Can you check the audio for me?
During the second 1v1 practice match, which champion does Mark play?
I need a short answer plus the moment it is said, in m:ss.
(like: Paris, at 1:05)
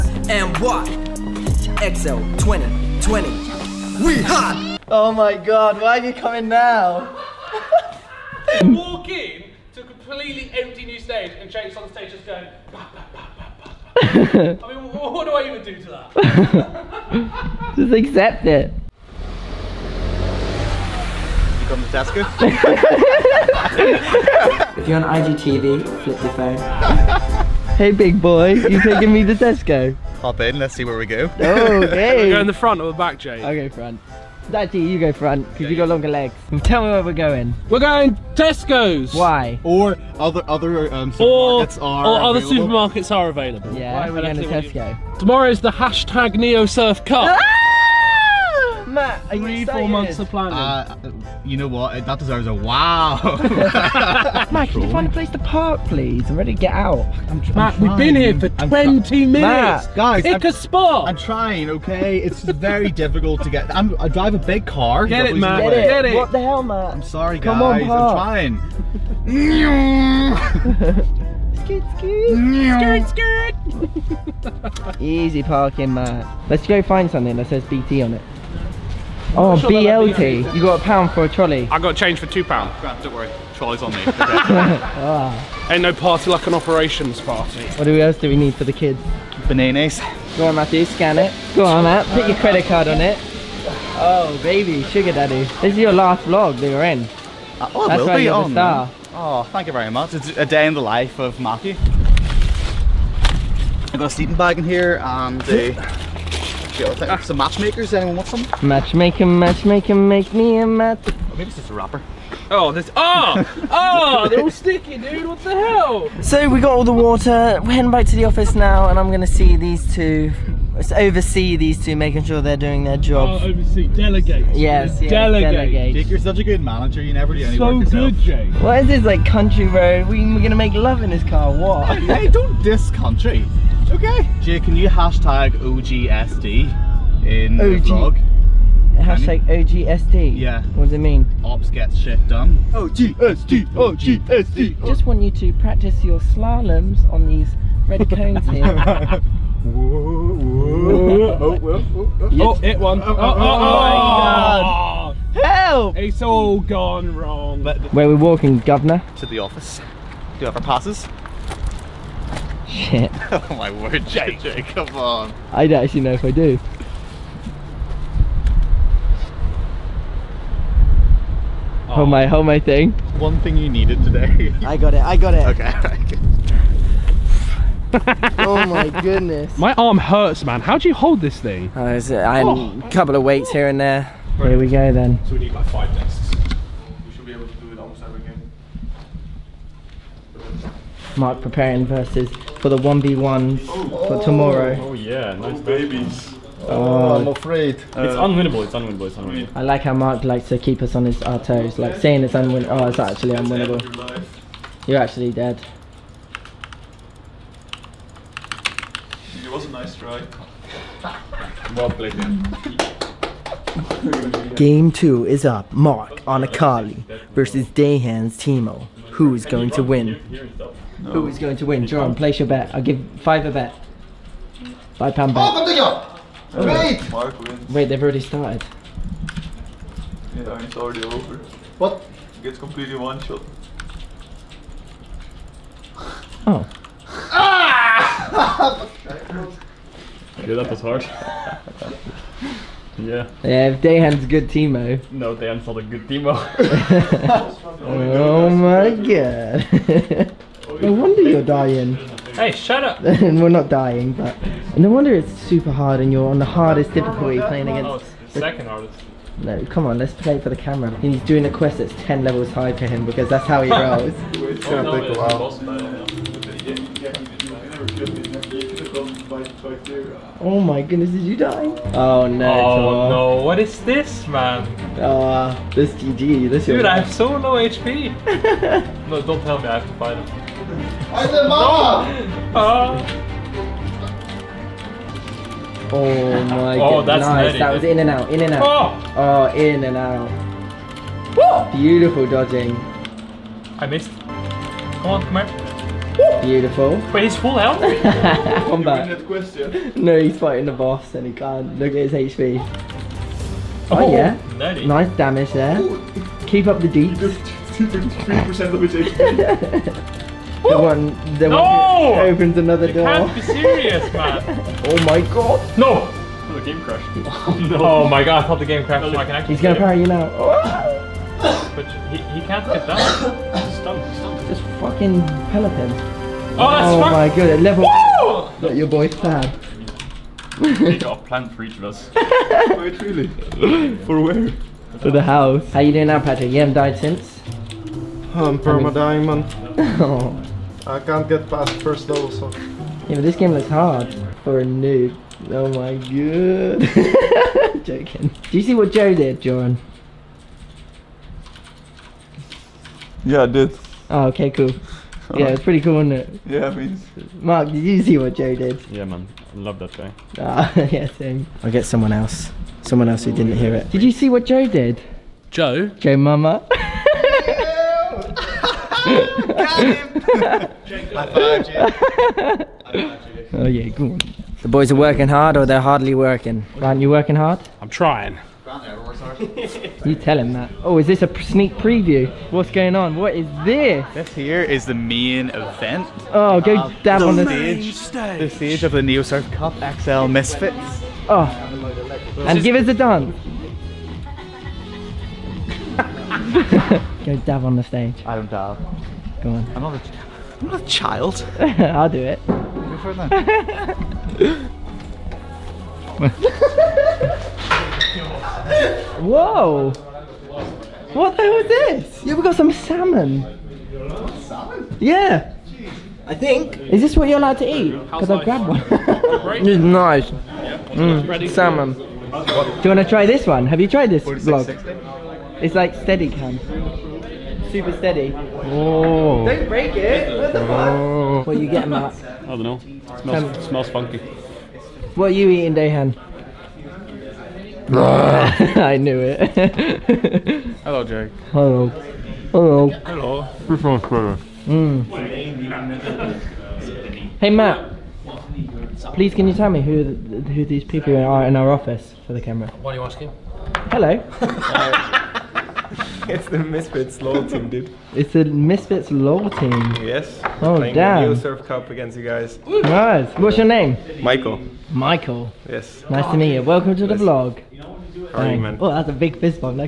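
Akali, at 3:36.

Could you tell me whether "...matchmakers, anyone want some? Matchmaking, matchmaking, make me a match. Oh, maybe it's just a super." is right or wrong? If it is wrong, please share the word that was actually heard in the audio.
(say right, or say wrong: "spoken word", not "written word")
wrong: "wrapper", not "super".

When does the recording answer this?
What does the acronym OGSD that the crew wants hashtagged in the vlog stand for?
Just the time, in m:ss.
2:21.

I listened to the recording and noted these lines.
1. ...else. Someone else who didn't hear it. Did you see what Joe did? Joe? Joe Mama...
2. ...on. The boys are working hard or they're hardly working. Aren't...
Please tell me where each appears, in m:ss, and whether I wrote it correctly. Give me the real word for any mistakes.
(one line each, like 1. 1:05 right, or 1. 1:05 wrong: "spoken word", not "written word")
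1. 6:02 right
2. 6:14 right.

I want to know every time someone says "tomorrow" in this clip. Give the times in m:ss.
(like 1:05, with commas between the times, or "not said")
0:45, 3:14.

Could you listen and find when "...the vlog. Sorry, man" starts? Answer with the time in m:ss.
7:47.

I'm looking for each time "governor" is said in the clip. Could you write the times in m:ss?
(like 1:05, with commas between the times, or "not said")
2:38.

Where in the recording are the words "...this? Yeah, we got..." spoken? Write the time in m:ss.
6:51.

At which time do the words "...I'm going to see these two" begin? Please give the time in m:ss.
1:58.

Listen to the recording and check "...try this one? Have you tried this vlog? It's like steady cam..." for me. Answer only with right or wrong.
right.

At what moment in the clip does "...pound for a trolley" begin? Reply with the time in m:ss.
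1:20.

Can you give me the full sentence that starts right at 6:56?
Is this what you're allowed to eat?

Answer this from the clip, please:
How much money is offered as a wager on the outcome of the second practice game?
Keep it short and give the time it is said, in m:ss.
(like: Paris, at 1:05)
5 pounds, at 3:44.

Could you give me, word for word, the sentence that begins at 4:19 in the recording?
No, come on, let's play for the camera.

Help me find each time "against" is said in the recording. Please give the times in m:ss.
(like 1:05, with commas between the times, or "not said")
4:17, 7:41.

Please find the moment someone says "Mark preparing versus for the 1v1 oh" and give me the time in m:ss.
3:11.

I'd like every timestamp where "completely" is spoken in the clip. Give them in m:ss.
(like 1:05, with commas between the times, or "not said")
0:09, 3:52.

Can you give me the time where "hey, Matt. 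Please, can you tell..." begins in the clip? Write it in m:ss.
7:27.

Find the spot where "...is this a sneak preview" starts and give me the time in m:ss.
6:20.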